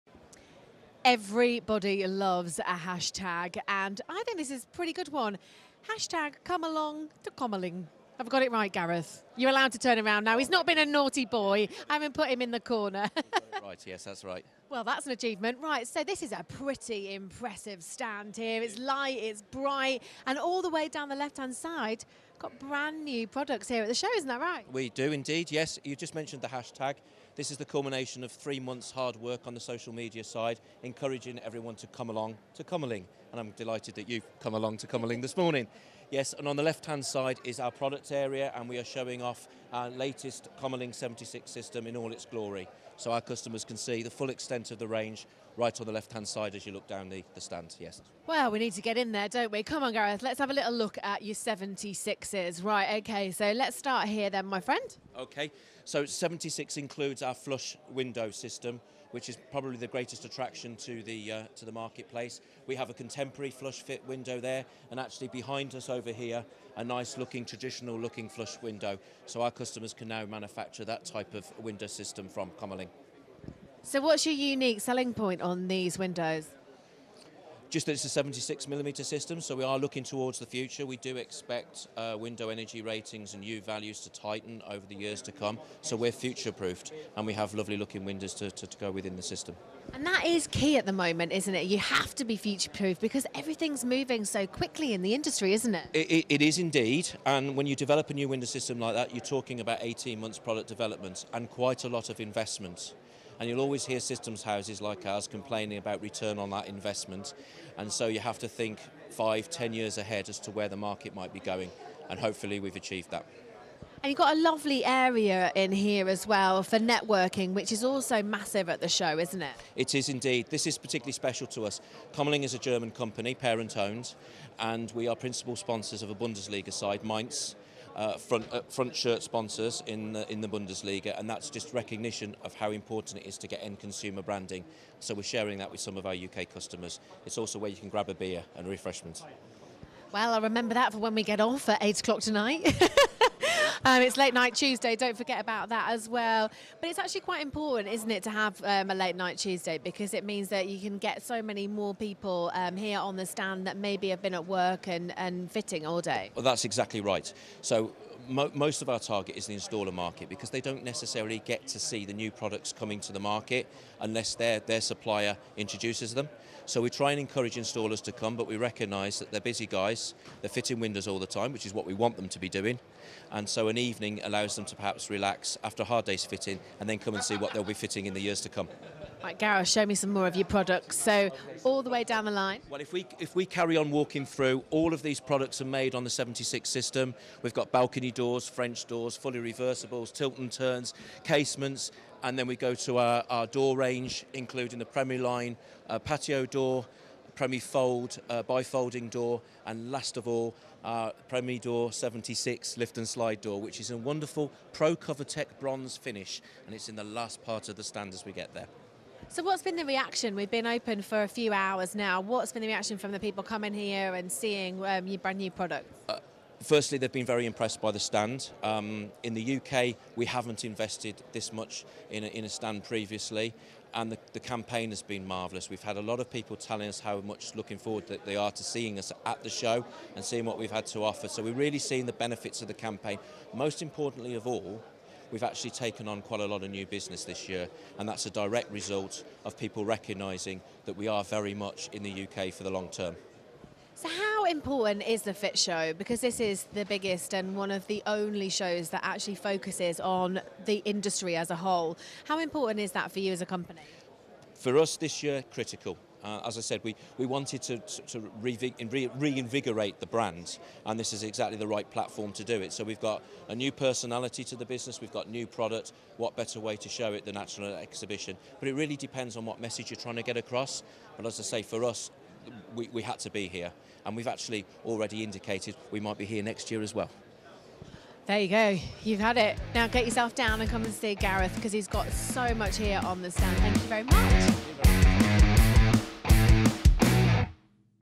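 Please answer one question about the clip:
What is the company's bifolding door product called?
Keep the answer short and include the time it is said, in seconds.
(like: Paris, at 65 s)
PremiFold, at 197 s.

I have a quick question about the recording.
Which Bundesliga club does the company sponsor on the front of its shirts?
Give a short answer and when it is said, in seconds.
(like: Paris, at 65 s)
Mainz, at 127 s.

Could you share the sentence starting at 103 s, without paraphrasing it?
And you'll always hear systems houses like ours complaining about return on that investment.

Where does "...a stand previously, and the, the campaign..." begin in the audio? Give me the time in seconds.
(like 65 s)
222 s.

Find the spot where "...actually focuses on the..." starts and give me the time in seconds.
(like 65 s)
249 s.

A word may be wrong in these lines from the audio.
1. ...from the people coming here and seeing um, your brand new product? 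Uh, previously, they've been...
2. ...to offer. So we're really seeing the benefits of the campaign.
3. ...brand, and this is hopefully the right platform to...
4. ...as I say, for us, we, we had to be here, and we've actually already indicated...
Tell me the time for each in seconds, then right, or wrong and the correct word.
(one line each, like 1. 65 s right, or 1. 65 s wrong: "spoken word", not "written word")
1. 212 s wrong: "firstly", not "previously"
2. 230 s right
3. 260 s wrong: "exactly", not "hopefully"
4. 271 s right.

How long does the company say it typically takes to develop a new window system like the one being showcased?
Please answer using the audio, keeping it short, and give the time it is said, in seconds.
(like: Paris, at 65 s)
18 months, at 99 s.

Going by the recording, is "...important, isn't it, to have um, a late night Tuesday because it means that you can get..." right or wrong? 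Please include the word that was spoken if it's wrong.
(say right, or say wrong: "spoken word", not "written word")
right.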